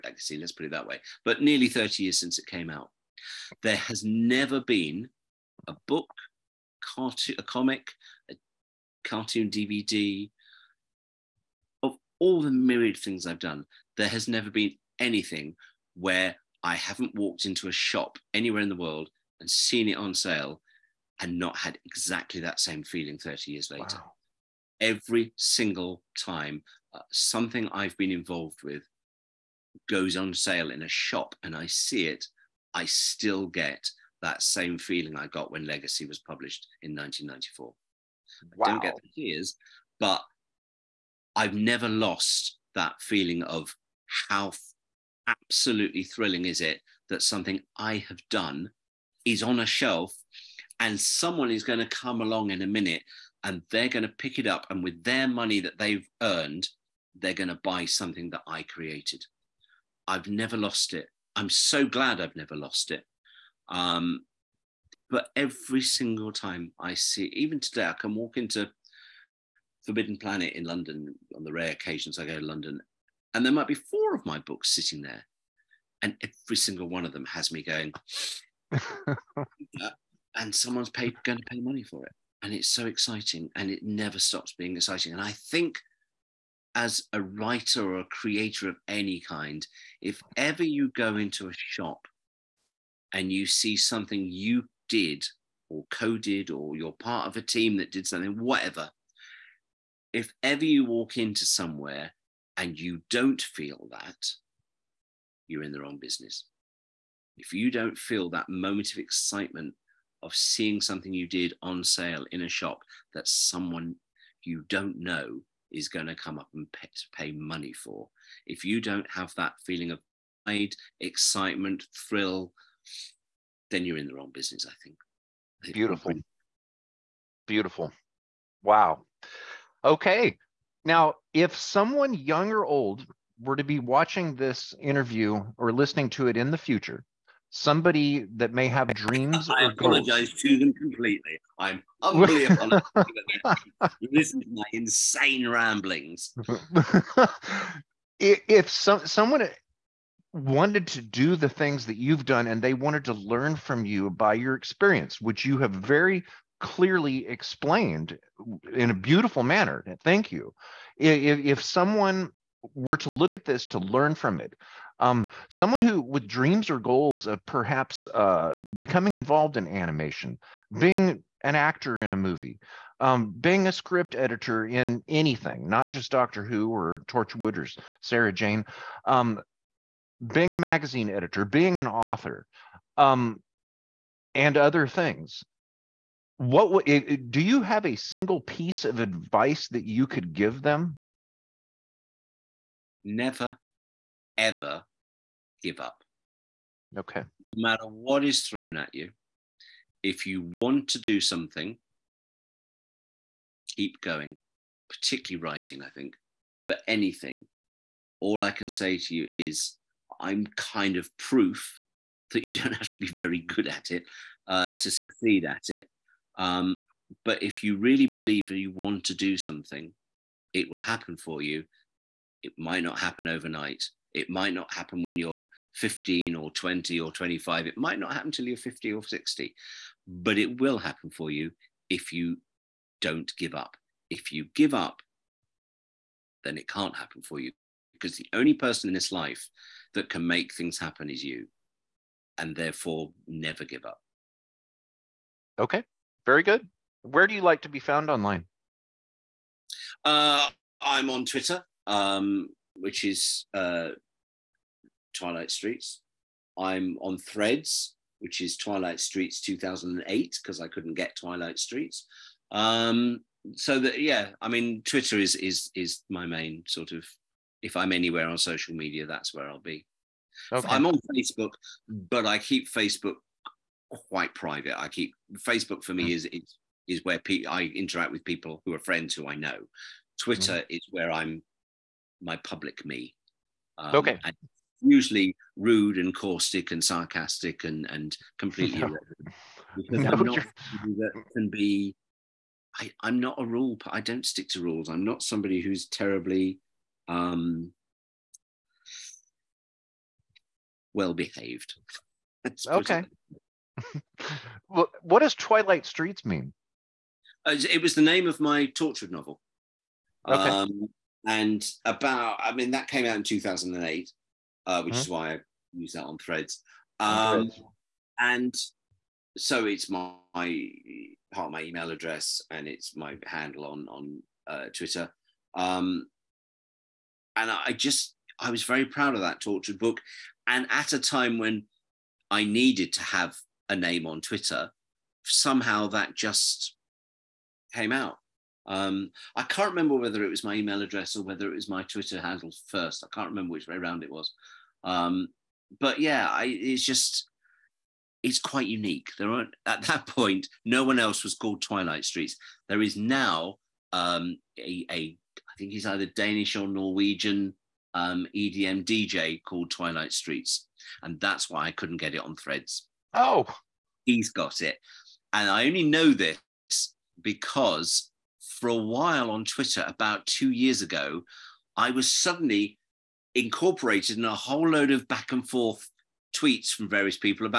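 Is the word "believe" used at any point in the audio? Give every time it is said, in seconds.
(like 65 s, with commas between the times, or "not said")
218 s.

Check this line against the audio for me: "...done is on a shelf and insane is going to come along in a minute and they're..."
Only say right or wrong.
wrong.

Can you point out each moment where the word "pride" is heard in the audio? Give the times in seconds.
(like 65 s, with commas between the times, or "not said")
120 s.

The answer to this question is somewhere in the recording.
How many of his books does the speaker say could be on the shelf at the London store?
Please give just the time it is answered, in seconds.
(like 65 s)
73 s.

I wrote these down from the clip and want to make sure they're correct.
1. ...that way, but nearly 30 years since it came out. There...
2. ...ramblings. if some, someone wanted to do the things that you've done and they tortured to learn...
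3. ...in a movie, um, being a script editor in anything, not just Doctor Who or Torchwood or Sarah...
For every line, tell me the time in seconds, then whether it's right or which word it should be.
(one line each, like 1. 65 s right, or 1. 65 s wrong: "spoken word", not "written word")
1. 0 s right
2. 145 s wrong: "wanted", not "tortured"
3. 171 s right.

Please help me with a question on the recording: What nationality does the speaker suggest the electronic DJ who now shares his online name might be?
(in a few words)
Danish or Norwegian.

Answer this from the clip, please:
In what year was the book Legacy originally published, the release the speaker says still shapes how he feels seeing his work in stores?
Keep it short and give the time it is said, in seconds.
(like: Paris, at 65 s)
1994, at 36 s.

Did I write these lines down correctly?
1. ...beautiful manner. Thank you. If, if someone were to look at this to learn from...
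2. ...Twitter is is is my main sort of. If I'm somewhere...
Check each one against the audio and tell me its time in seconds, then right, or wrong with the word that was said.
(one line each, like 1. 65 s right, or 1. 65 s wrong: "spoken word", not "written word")
1. 158 s right
2. 264 s wrong: "anywhere", not "somewhere".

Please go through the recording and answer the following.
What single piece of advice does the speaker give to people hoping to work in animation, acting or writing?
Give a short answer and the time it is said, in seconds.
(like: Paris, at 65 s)
Never ever give up, at 193 s.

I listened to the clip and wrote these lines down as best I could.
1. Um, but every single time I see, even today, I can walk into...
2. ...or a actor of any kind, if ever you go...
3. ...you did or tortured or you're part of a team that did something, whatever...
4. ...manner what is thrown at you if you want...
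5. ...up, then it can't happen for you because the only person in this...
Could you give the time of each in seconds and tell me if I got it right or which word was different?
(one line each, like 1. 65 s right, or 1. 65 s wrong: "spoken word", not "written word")
1. 63 s right
2. 87 s wrong: "creator", not "actor"
3. 94 s wrong: "coded", not "tortured"
4. 197 s wrong: "matter", not "manner"
5. 234 s right.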